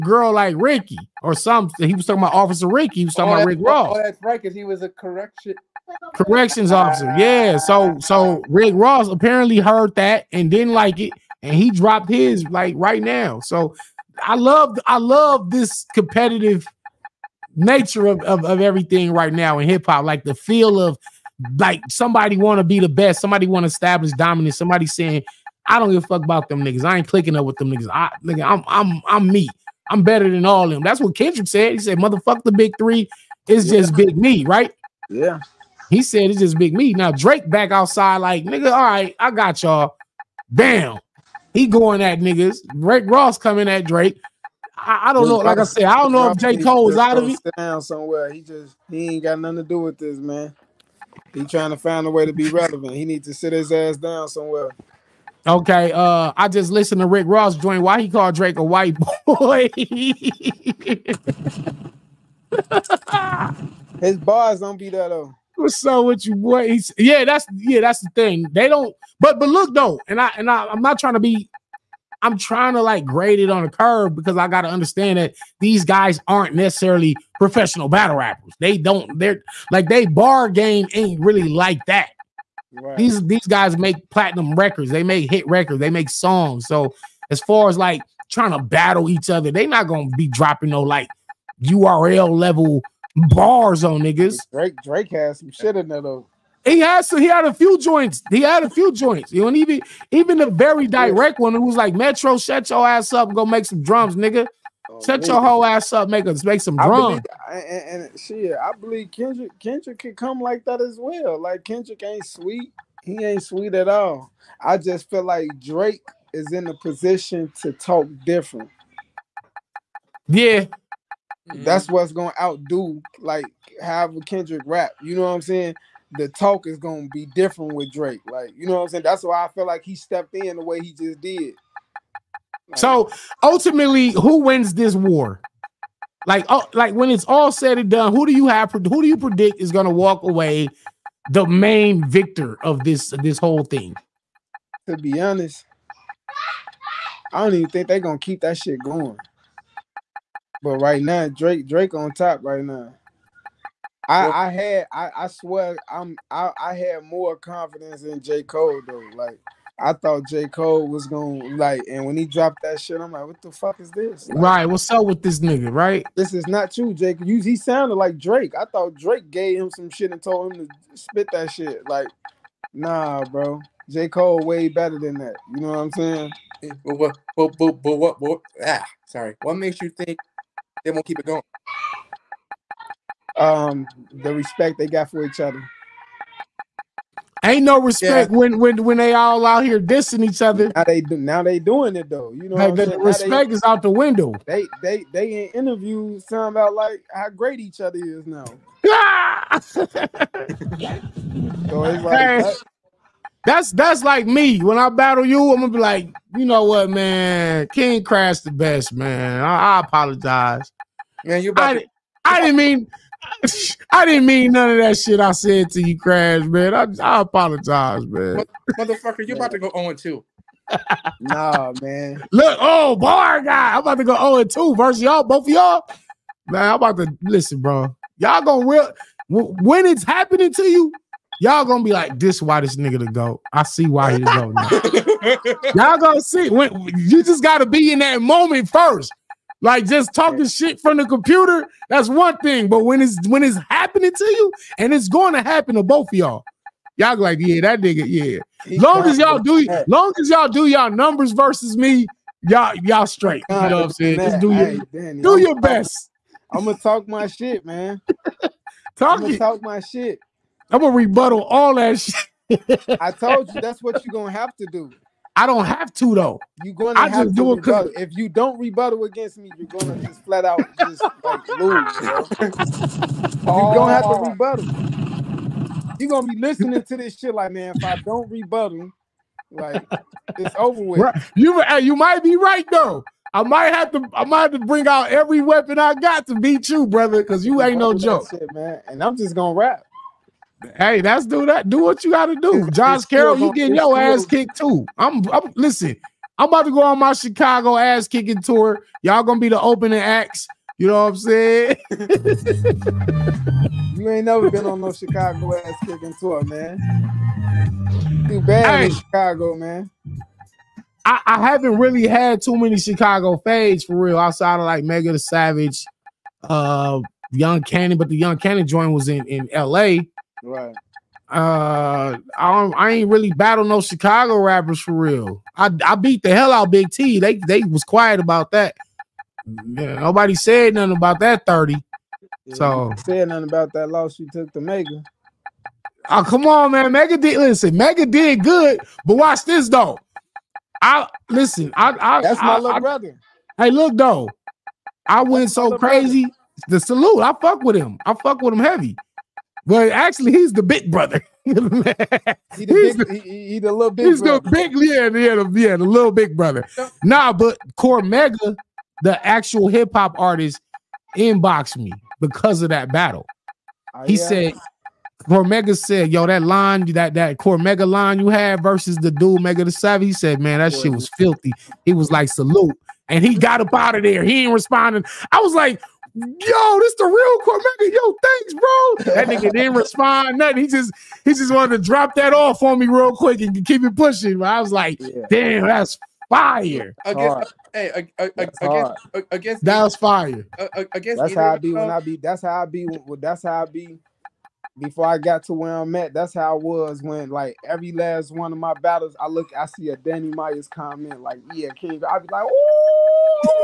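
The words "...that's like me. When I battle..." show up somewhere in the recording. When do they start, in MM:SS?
03:23.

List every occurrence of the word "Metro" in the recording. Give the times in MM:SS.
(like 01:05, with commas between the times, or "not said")
01:41.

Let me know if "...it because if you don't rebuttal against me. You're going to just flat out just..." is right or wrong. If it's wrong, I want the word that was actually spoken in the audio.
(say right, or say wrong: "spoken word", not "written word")
right.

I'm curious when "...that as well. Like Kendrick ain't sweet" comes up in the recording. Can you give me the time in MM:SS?
01:50.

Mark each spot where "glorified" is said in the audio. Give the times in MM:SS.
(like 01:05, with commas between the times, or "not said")
not said.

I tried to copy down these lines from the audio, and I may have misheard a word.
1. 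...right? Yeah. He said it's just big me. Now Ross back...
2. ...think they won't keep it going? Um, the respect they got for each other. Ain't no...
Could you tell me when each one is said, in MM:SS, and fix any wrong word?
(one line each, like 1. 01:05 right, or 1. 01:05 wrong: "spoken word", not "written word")
1. 00:34 wrong: "Drake", not "Ross"
2. 02:59 right.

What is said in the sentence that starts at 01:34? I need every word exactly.
Drake Drake has some shit in there though.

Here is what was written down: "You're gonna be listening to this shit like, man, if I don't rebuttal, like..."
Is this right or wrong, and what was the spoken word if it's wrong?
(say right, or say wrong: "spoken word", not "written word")
right.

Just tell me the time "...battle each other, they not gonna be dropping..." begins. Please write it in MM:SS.
01:28.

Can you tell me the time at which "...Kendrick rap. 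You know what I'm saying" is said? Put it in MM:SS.
02:04.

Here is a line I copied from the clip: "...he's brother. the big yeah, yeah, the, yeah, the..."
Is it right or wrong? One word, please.
right.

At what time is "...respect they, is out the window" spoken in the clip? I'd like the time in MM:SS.
03:12.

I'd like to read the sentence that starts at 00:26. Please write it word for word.
I ain't clicking up with them niggas.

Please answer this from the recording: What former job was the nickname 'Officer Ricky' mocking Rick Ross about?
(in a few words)
Corrections officer.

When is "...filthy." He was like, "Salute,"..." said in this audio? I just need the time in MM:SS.
06:11.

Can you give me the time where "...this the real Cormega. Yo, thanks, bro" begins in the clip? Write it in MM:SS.
06:16.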